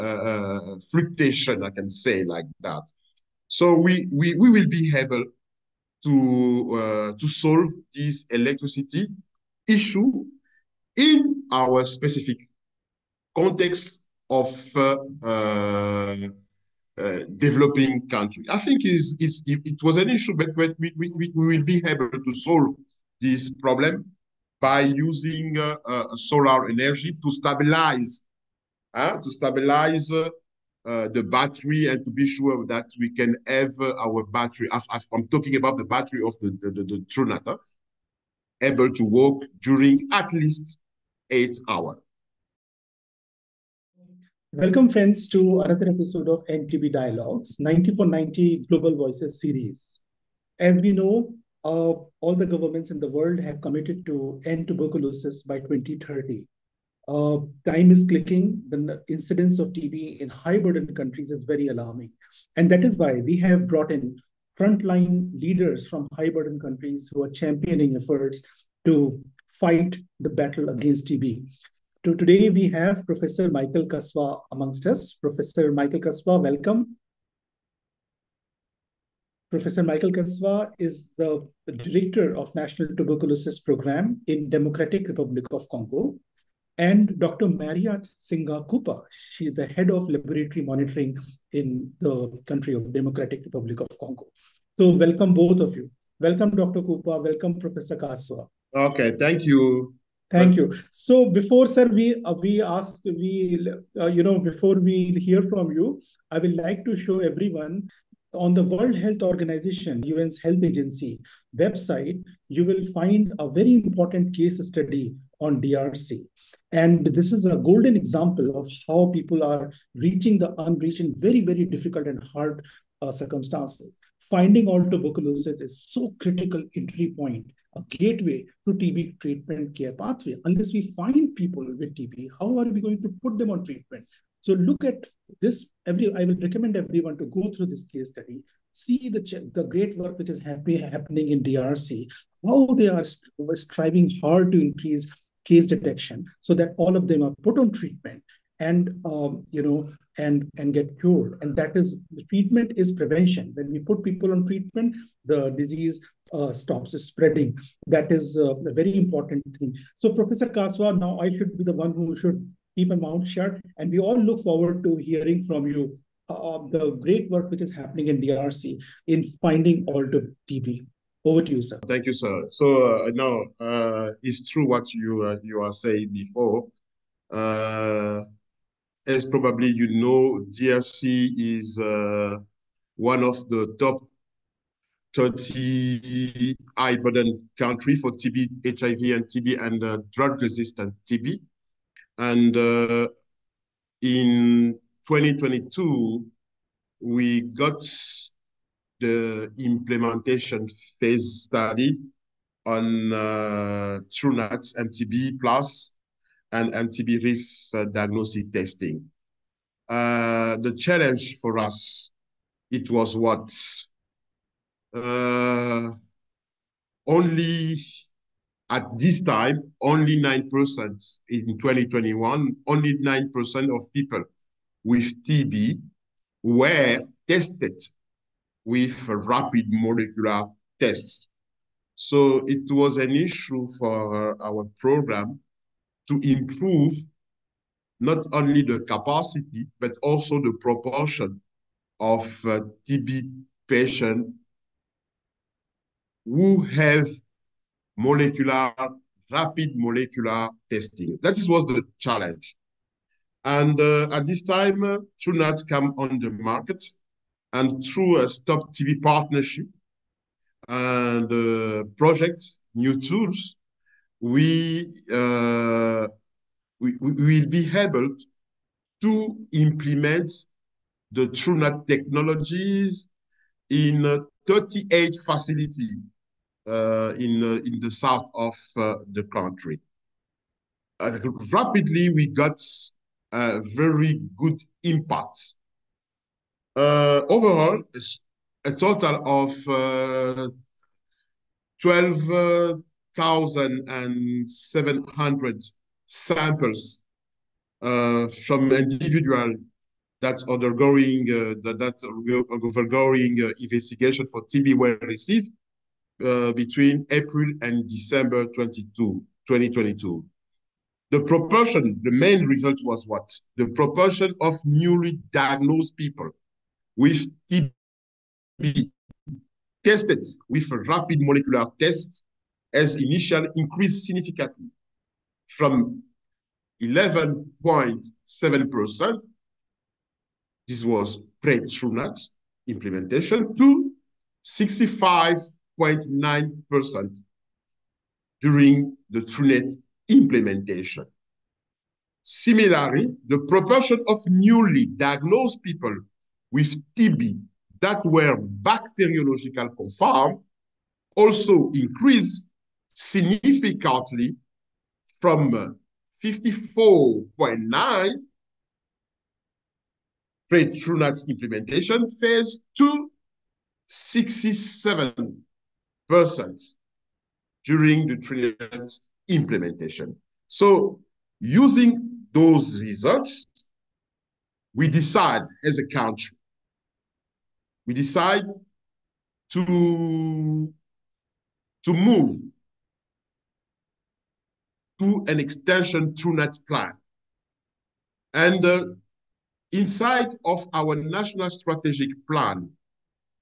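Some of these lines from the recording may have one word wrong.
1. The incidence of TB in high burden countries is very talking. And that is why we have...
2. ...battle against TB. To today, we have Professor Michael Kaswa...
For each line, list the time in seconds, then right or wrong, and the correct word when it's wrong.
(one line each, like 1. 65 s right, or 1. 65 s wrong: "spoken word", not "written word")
1. 58 s wrong: "alarming", not "talking"
2. 70 s right.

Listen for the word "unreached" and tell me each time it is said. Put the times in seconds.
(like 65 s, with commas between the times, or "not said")
120 s.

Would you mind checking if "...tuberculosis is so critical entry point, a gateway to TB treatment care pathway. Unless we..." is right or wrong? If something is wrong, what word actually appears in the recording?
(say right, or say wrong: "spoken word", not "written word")
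right.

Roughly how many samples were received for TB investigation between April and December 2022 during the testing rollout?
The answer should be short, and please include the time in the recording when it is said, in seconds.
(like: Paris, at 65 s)
12,700, at 291 s.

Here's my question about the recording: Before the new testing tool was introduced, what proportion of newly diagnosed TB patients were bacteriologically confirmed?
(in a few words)
54.9%.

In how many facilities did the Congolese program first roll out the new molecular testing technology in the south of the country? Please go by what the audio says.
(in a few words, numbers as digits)
38.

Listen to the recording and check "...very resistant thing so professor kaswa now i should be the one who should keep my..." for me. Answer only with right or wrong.
wrong.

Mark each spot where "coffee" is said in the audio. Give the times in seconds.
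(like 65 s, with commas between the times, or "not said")
not said.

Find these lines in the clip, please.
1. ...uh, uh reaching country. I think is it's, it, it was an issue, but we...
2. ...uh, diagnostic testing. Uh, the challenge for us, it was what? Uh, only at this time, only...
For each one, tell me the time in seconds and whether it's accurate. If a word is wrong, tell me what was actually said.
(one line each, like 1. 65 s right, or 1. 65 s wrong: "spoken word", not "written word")
1. 15 s wrong: "developing", not "reaching"
2. 207 s right.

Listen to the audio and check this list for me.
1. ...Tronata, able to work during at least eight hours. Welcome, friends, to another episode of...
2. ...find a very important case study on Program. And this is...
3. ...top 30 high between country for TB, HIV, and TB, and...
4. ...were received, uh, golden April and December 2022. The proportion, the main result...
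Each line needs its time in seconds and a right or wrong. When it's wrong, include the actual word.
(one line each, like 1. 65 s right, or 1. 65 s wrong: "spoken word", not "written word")
1. 37 s right
2. 112 s wrong: "DRC", not "Program"
3. 183 s wrong: "burden", not "between"
4. 304 s wrong: "between", not "golden".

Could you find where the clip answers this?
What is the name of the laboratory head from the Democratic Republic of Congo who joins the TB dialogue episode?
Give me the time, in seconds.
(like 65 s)
87 s.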